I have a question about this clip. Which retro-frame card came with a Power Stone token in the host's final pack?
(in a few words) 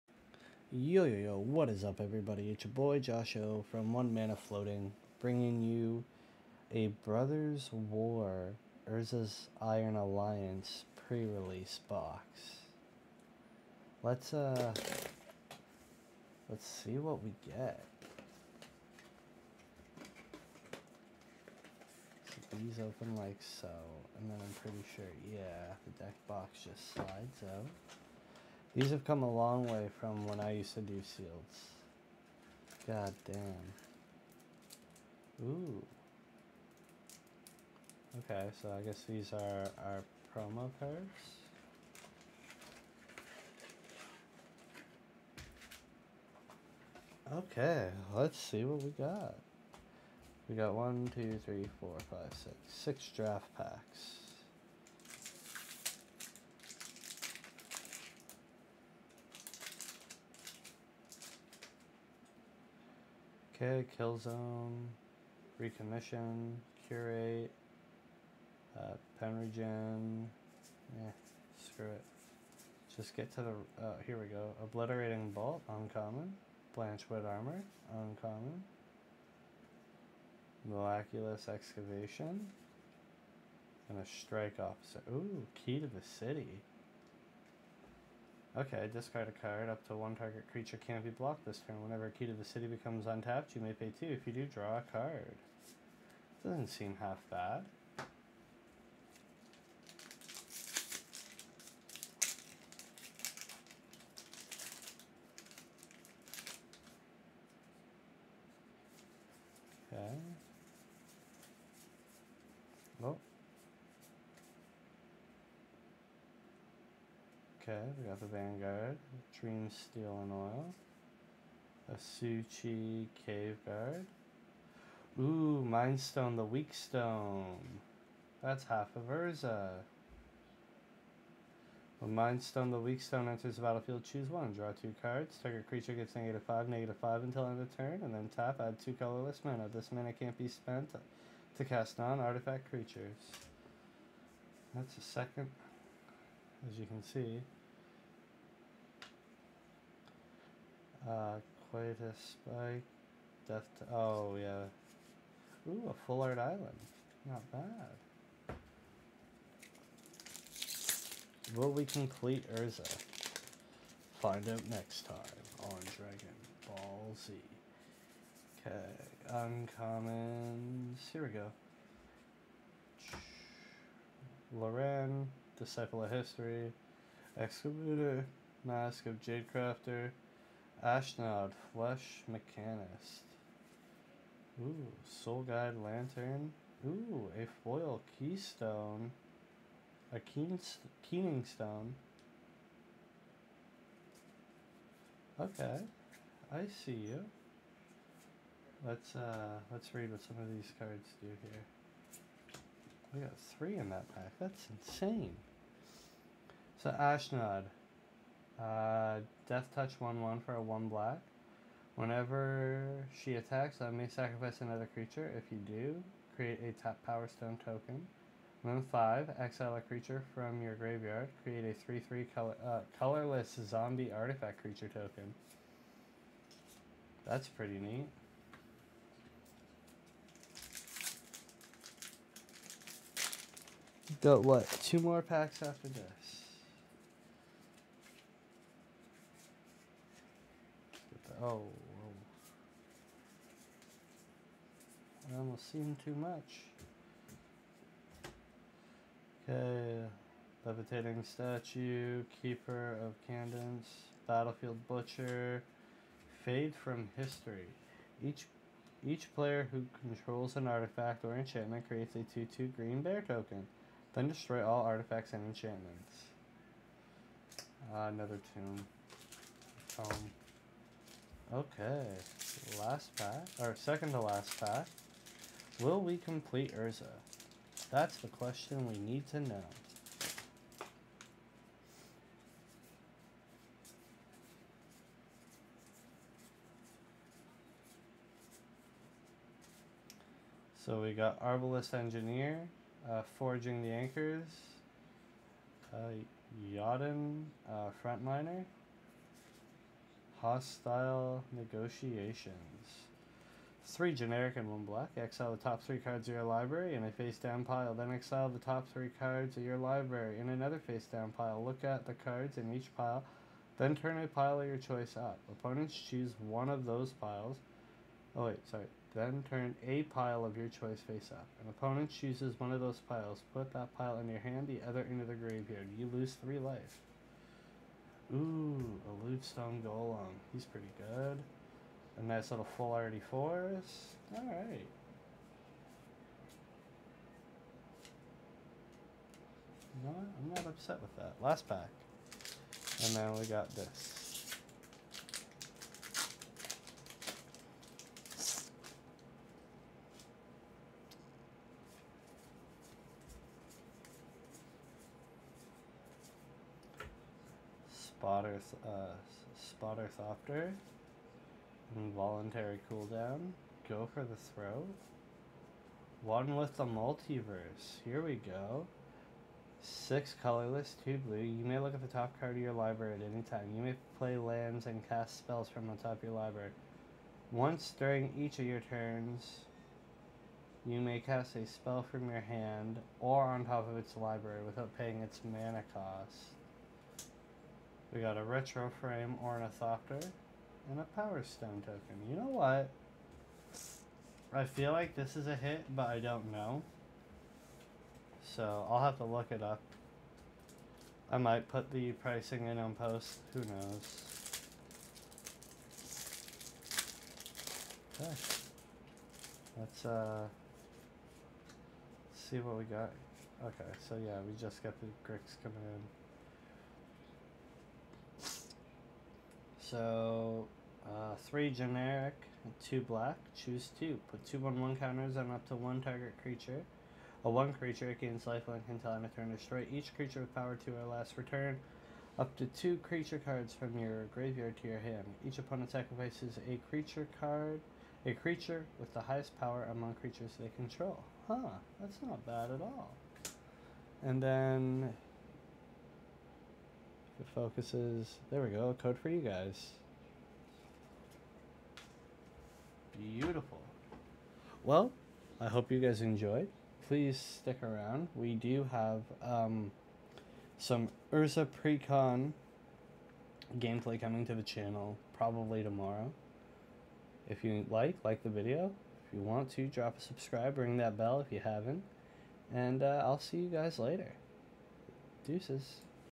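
Ornithopter.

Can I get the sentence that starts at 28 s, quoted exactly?
These have come a long way from when I used to do seals.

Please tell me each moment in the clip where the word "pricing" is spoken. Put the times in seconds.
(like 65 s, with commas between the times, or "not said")
402 s.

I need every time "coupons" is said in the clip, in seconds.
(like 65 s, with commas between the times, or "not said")
not said.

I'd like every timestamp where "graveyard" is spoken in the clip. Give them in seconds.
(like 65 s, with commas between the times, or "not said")
220 s, 325 s, 434 s.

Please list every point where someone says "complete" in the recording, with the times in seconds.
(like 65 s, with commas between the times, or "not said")
161 s, 276 s.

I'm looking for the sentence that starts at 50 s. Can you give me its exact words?
We got one, two, three, four, five, six.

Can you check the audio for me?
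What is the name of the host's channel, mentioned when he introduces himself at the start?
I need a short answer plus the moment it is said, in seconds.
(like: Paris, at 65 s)
One Mana Floating, at 3 s.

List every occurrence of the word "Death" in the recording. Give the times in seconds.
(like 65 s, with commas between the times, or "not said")
153 s, 209 s.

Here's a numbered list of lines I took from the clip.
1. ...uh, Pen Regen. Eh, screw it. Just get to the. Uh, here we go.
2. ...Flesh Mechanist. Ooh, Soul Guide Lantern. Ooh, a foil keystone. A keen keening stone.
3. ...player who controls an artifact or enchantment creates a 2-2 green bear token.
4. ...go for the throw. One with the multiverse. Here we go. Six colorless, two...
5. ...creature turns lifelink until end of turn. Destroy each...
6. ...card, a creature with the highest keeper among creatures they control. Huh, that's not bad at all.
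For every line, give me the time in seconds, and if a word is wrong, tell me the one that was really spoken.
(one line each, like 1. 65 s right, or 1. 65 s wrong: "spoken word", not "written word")
1. 68 s right
2. 181 s right
3. 259 s right
4. 363 s right
5. 427 s wrong: "gains", not "turns"
6. 437 s wrong: "power", not "keeper".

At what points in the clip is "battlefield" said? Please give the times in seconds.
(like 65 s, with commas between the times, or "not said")
133 s, 254 s.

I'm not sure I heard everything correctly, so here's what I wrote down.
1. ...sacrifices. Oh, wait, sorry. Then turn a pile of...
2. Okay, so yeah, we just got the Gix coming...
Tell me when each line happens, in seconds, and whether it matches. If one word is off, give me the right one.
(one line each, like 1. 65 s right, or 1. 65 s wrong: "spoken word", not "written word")
1. 317 s wrong: "piles", not "sacrifices"
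2. 413 s right.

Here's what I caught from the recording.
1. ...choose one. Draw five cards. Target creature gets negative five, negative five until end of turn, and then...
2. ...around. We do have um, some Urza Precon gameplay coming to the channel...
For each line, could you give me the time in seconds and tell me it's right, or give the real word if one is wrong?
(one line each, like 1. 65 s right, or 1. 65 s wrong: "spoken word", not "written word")
1. 134 s wrong: "two", not "five"
2. 457 s right.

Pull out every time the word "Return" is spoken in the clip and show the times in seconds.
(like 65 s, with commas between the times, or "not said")
431 s.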